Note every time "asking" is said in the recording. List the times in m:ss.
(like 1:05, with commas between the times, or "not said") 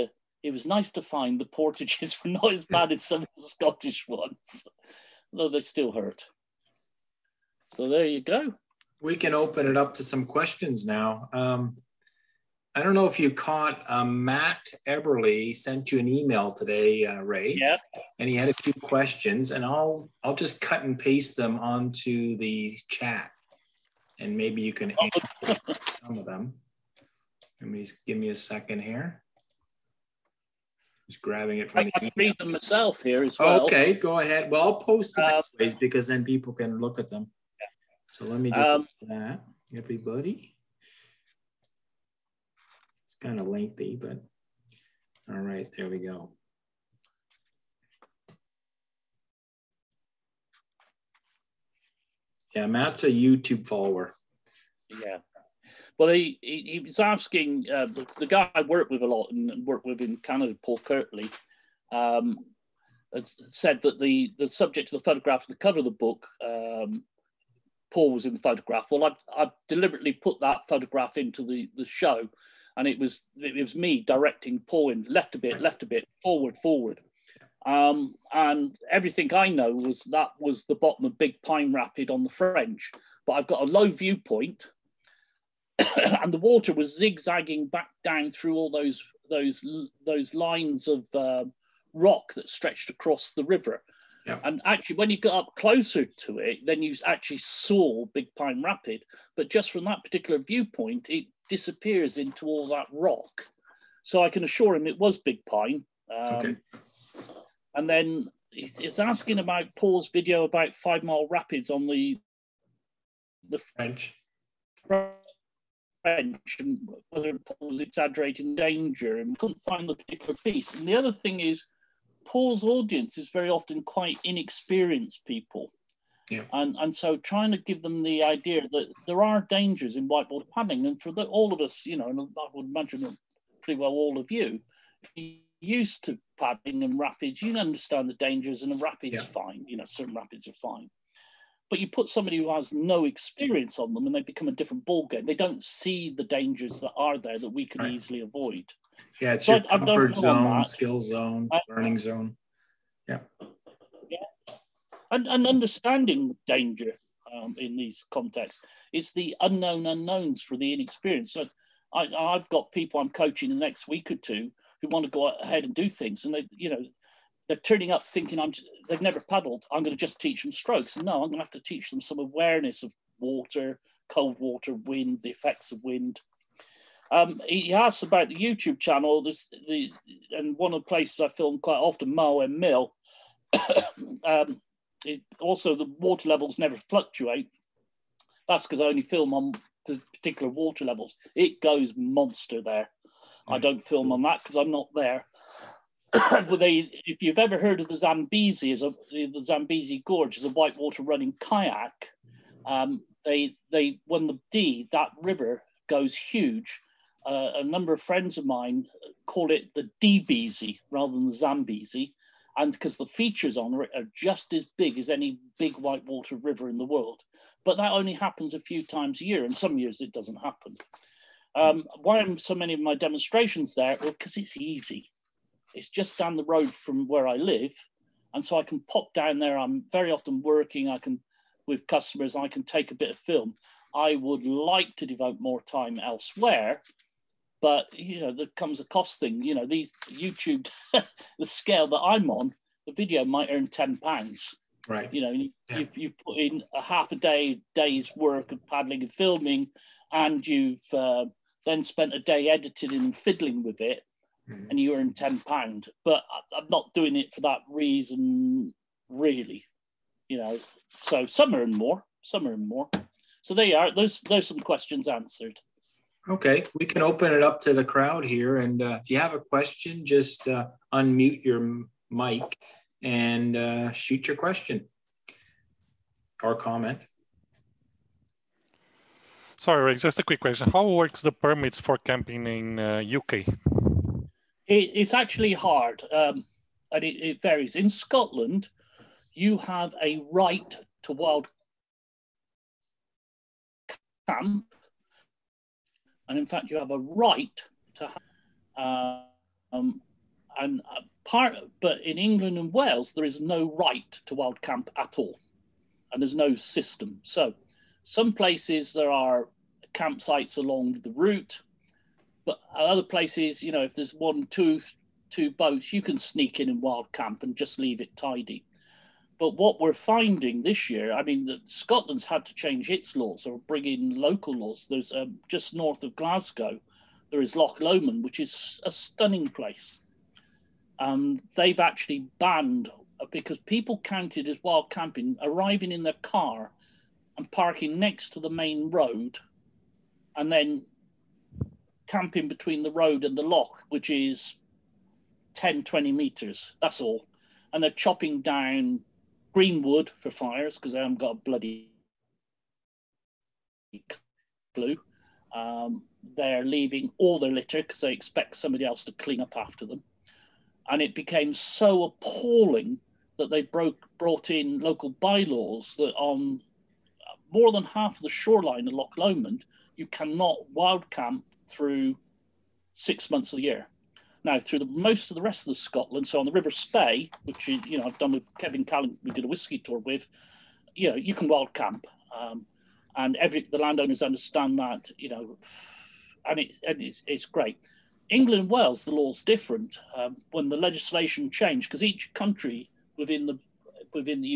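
0:56, 1:48.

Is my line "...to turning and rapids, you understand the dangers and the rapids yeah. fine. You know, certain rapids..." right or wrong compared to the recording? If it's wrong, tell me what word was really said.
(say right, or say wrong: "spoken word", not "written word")
wrong: "padding", not "turning".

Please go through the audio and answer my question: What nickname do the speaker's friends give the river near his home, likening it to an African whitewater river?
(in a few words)
DBZ.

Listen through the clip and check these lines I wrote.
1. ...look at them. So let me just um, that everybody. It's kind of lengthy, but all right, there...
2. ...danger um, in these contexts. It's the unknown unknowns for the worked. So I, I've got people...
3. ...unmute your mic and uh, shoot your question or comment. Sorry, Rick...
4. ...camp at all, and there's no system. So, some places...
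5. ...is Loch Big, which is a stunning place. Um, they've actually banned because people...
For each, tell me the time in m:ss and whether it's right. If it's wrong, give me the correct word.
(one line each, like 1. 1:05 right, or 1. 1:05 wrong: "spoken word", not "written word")
1. 0:36 right
2. 2:36 wrong: "inexperienced", not "worked"
3. 4:30 right
4. 5:04 right
5. 5:27 wrong: "Lomond", not "Big".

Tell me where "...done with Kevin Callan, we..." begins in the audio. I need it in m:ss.
6:18.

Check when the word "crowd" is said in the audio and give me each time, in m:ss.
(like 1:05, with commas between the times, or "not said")
4:27.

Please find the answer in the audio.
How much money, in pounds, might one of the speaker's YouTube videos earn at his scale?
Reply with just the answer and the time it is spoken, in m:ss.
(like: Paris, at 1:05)
10 pounds, at 4:03.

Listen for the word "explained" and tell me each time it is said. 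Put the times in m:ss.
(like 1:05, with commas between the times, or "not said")
not said.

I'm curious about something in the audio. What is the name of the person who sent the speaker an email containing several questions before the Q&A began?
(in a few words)
Matt Eberly.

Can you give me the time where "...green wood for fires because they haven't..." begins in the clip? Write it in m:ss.
5:49.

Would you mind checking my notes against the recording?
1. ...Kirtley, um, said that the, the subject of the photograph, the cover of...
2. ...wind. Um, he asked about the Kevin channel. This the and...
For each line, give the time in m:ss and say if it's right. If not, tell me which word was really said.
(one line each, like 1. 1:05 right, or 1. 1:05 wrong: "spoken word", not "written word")
1. 1:00 right
2. 2:55 wrong: "YouTube", not "Kevin".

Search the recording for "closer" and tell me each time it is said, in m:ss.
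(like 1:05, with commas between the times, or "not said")
1:35.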